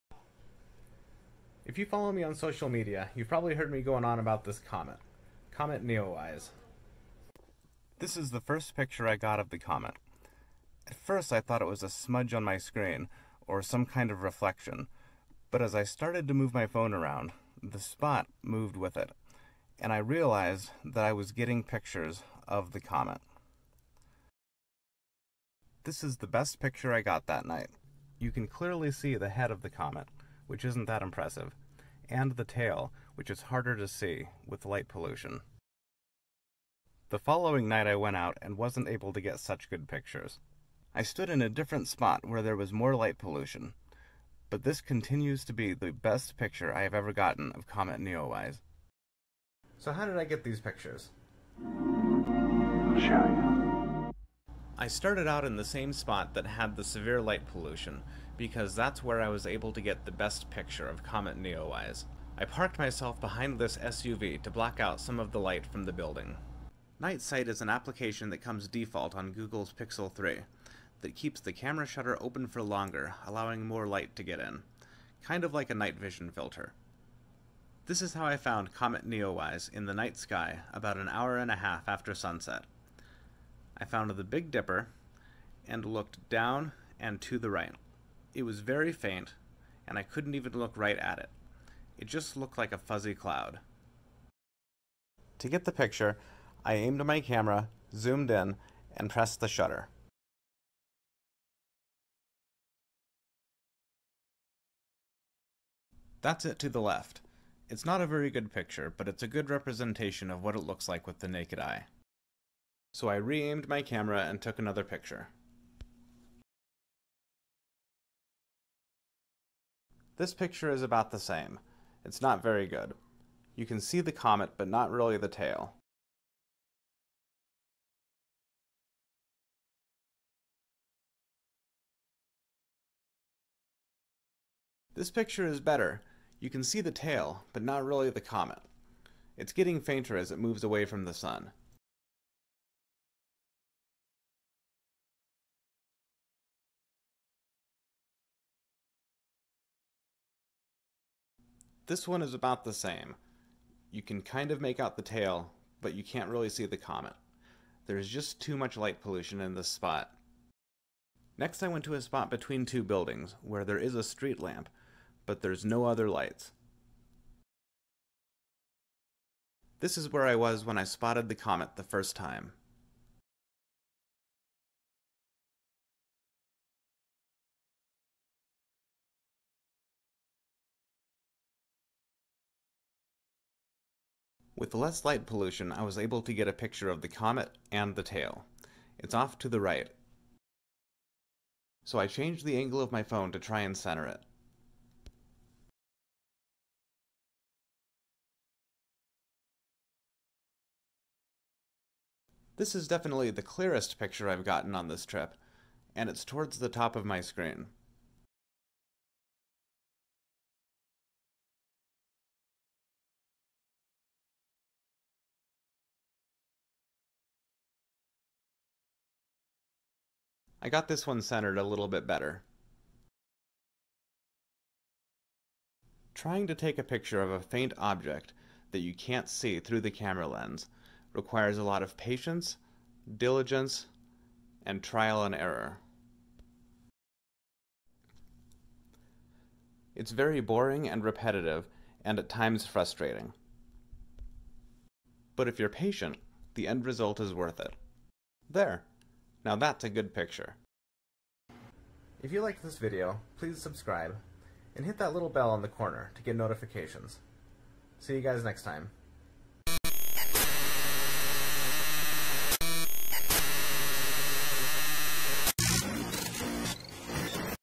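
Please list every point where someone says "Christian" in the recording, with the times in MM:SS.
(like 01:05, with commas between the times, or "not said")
not said.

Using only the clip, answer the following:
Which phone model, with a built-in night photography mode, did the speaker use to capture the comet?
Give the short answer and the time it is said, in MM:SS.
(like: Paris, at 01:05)
Pixel 3, at 01:09.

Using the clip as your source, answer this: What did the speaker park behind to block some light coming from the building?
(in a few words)
SUV.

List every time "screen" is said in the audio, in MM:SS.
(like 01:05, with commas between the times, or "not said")
00:12, 03:27.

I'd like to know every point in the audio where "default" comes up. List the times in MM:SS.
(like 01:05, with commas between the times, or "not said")
01:08.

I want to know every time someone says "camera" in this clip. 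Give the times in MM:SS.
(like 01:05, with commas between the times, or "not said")
01:11, 01:37, 01:53, 03:49.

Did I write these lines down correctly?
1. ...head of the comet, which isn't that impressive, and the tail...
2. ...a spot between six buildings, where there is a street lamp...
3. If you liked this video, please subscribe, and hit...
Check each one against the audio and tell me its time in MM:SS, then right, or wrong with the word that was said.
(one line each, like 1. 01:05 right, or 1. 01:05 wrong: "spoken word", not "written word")
1. 00:29 right
2. 02:41 wrong: "two", not "six"
3. 04:12 right.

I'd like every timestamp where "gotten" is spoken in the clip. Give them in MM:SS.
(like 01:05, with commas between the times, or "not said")
00:47, 03:24.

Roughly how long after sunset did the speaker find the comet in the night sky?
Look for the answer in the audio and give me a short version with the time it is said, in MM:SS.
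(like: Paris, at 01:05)
an hour and a half, at 01:20.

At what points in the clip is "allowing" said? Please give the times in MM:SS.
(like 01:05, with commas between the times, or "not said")
01:13.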